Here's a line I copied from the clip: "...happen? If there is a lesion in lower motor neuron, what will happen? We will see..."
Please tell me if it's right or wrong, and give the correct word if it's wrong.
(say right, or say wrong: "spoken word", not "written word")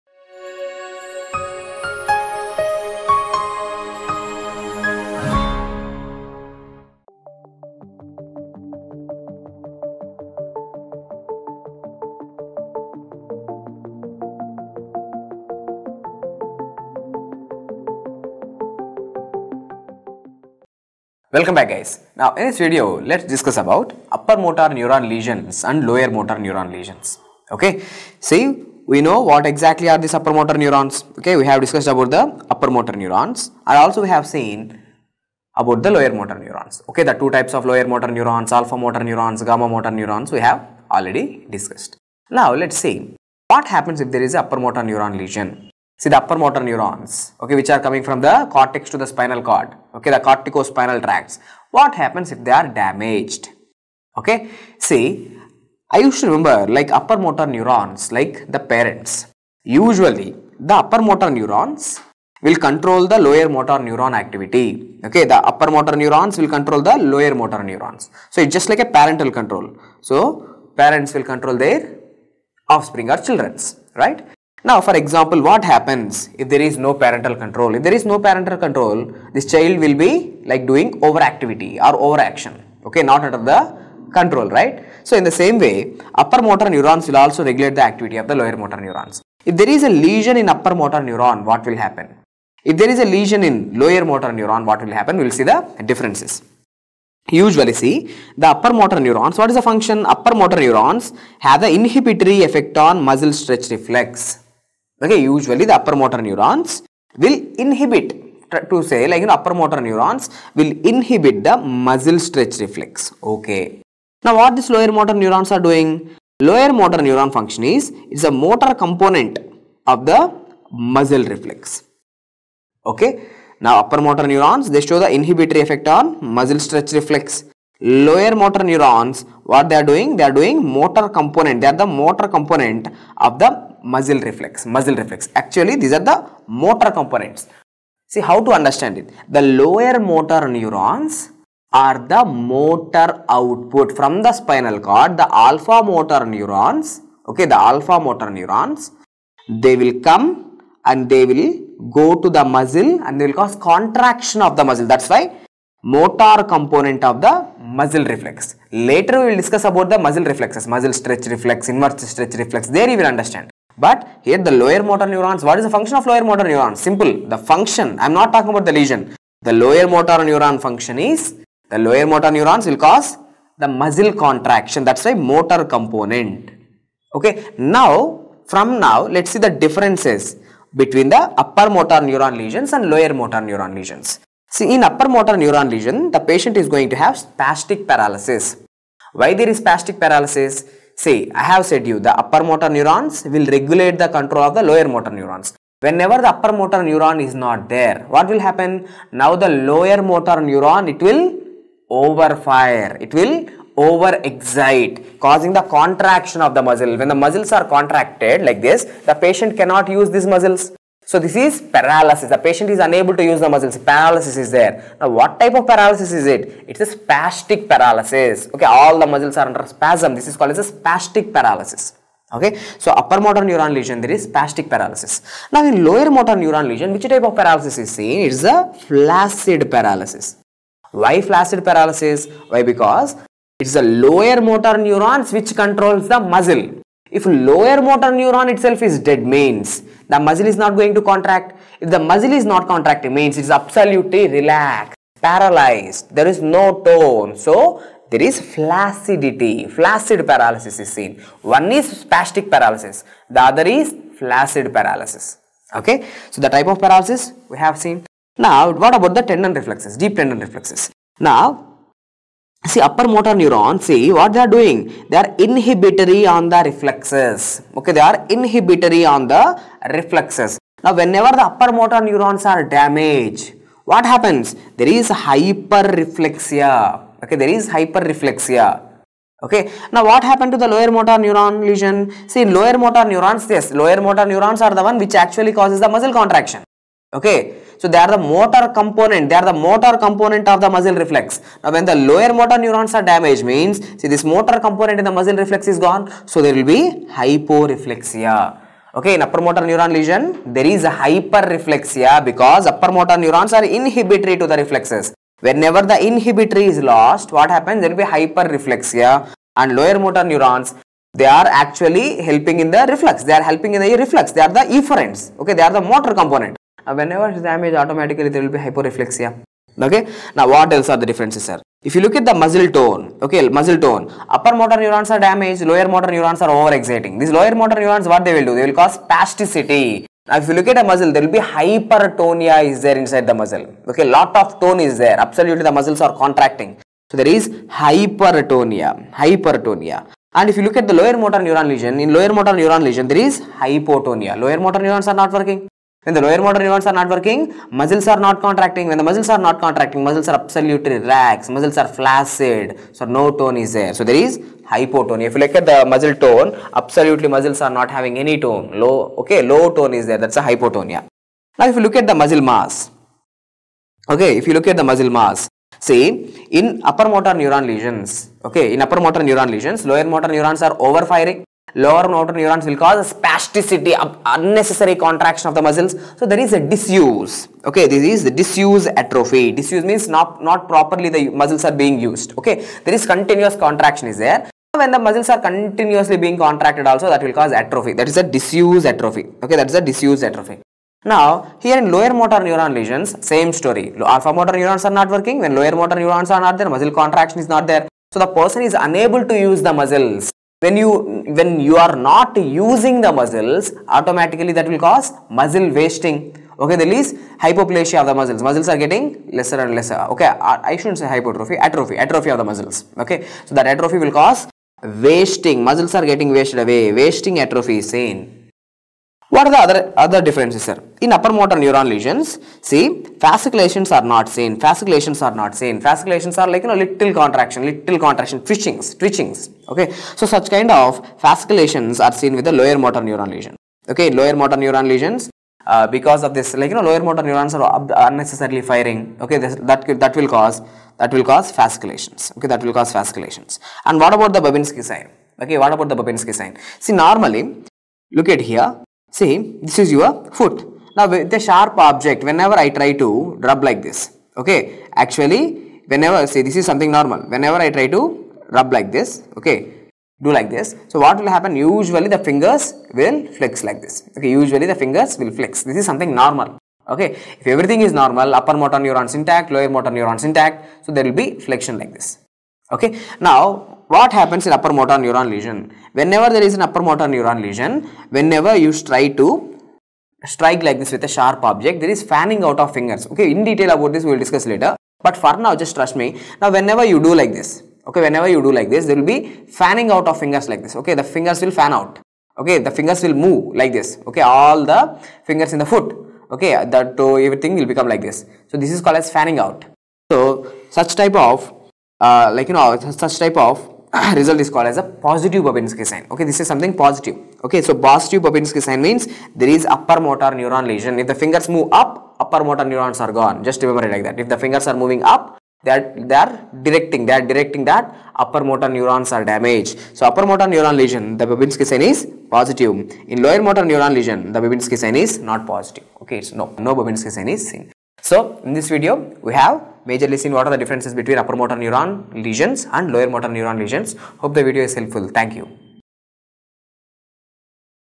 right.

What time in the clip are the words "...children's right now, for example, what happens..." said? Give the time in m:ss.
1:13.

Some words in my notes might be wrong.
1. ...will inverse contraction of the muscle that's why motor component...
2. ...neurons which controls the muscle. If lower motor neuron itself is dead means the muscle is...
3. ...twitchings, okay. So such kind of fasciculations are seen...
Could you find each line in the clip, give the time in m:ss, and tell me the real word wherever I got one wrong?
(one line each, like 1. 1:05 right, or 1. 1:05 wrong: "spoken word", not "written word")
1. 2:33 wrong: "cause", not "inverse"
2. 3:54 right
3. 7:08 right.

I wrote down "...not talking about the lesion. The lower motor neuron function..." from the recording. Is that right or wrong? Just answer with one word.
right.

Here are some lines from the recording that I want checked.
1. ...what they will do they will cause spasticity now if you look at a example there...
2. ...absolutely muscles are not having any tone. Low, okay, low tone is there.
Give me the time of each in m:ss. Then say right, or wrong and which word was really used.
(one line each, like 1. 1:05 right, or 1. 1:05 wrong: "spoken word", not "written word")
1. 5:28 wrong: "muscle", not "example"
2. 5:56 right.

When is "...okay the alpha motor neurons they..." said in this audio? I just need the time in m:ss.
2:27.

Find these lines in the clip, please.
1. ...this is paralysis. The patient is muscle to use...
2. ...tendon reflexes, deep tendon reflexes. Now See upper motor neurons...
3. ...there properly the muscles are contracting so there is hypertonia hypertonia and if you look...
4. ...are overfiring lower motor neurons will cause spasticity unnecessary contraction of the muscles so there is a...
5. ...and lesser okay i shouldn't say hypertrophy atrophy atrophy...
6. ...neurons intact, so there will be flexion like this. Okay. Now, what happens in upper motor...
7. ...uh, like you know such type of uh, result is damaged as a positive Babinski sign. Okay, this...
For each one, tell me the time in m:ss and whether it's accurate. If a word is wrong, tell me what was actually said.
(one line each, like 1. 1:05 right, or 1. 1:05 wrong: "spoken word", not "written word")
1. 3:31 wrong: "unable", not "muscle"
2. 4:19 right
3. 5:35 wrong: "absolutely", not "properly"
4. 6:10 right
5. 6:49 right
6. 7:49 right
7. 8:22 wrong: "called", not "damaged".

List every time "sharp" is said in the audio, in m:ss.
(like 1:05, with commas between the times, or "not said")
7:31, 8:01.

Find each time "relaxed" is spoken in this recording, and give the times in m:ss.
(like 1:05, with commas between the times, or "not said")
4:04, 5:50.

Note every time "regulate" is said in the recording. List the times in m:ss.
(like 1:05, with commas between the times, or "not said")
1:27, 3:13.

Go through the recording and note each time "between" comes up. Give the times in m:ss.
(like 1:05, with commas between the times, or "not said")
3:00, 8:51.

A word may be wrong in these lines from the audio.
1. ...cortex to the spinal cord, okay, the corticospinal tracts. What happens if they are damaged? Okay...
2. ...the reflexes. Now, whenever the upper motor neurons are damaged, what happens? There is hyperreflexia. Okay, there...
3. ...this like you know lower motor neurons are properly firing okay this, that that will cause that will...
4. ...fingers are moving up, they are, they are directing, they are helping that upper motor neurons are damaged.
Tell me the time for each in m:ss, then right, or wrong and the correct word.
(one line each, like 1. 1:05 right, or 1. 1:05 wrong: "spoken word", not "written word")
1. 0:48 right
2. 4:29 right
3. 7:16 wrong: "unnecessarily", not "properly"
4. 8:34 wrong: "directing", not "helping".